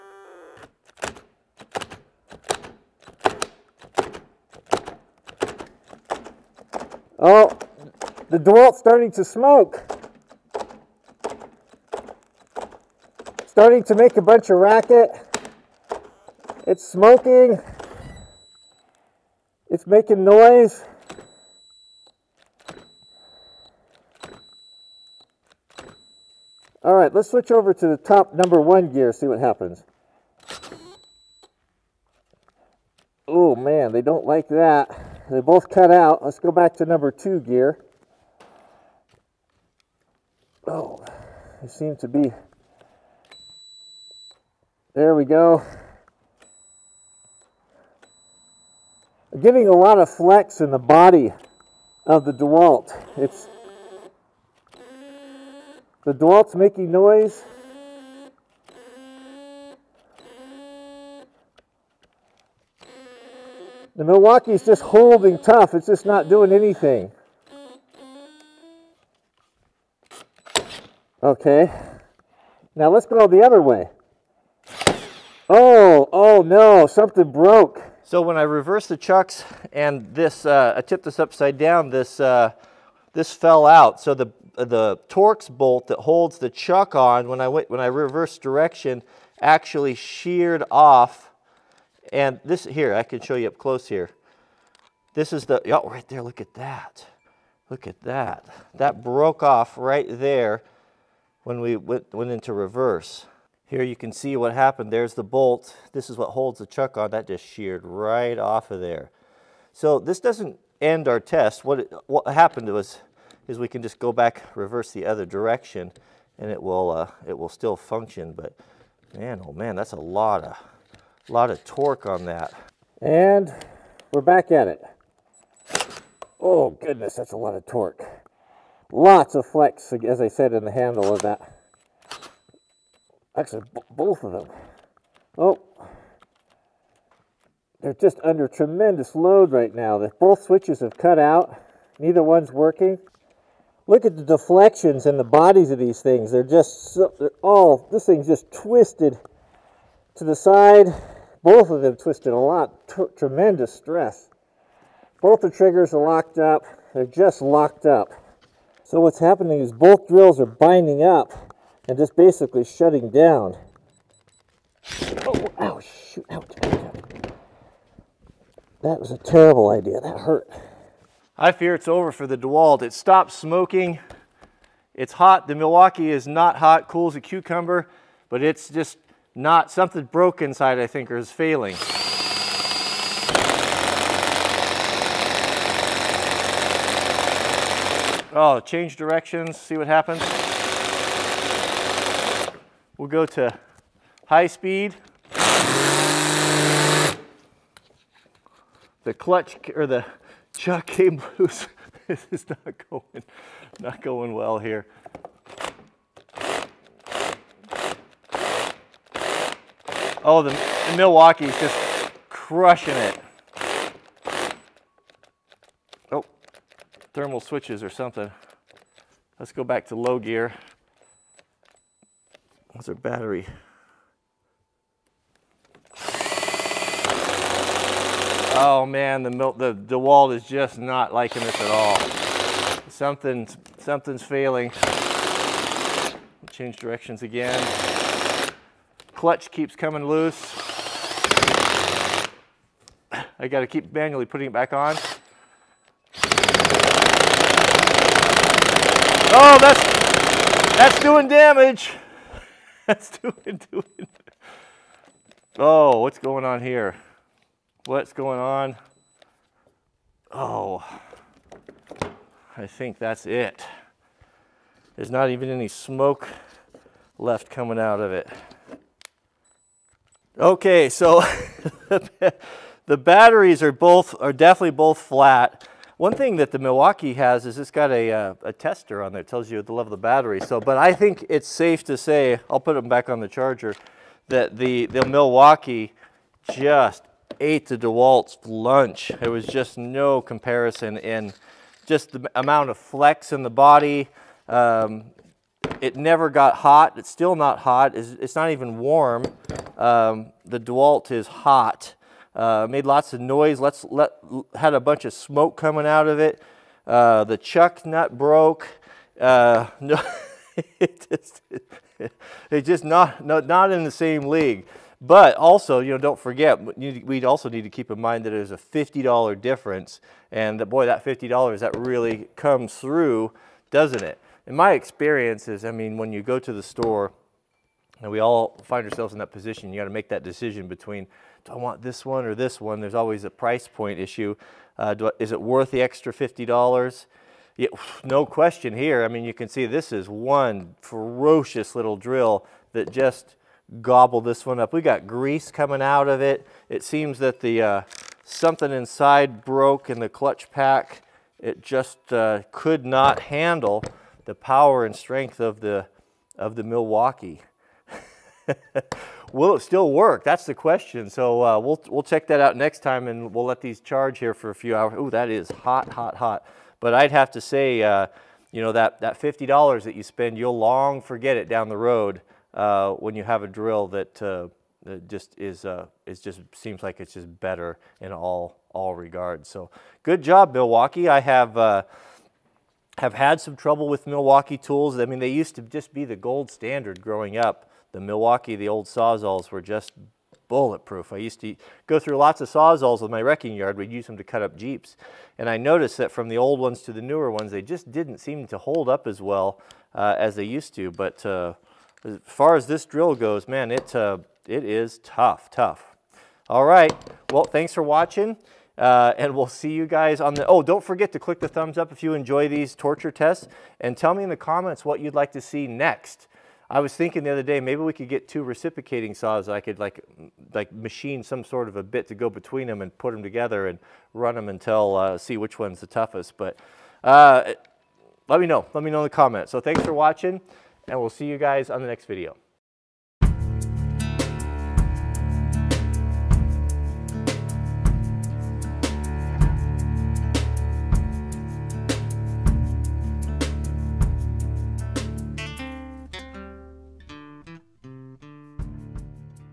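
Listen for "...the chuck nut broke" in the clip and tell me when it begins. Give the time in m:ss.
5:07.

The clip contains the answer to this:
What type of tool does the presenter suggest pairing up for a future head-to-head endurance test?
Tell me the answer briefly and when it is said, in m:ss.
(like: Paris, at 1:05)
Reciprocating saws, at 6:58.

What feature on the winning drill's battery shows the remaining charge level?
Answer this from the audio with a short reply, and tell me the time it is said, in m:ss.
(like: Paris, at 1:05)
A tester, at 4:38.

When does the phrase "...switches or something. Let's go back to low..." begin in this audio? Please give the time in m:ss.
3:37.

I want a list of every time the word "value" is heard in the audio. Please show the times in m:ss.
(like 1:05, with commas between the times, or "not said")
not said.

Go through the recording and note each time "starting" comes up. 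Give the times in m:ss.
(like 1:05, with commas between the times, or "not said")
0:08, 0:13.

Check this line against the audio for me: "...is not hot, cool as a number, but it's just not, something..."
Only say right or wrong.
wrong.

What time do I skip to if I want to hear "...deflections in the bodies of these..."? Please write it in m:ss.
2:24.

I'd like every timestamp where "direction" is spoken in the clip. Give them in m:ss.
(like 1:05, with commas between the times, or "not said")
1:28, 1:55, 3:08, 3:56.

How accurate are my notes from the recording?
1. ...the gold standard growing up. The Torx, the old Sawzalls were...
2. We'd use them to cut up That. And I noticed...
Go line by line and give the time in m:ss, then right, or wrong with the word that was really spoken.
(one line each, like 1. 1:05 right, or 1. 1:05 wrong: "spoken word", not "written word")
1. 6:26 wrong: "Milwaukee", not "Torx"
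2. 6:33 wrong: "Jeeps", not "That".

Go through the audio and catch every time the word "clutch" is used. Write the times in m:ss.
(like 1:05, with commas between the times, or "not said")
3:19, 3:59, 5:50.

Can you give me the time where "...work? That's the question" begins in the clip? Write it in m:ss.
5:59.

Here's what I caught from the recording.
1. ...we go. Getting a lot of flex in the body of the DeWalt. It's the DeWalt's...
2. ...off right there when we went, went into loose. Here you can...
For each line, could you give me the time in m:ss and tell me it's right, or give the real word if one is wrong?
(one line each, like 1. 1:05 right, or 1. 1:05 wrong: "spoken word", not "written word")
1. 0:45 right
2. 1:39 wrong: "reverse", not "loose".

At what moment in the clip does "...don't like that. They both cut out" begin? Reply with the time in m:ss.
0:34.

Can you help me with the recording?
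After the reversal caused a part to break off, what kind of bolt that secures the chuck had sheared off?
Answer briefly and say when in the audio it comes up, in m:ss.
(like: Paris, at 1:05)
Torx bolt, at 1:25.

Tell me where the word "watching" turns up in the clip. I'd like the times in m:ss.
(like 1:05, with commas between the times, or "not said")
6:47, 7:09.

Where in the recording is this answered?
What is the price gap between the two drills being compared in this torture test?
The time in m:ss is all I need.
5:18.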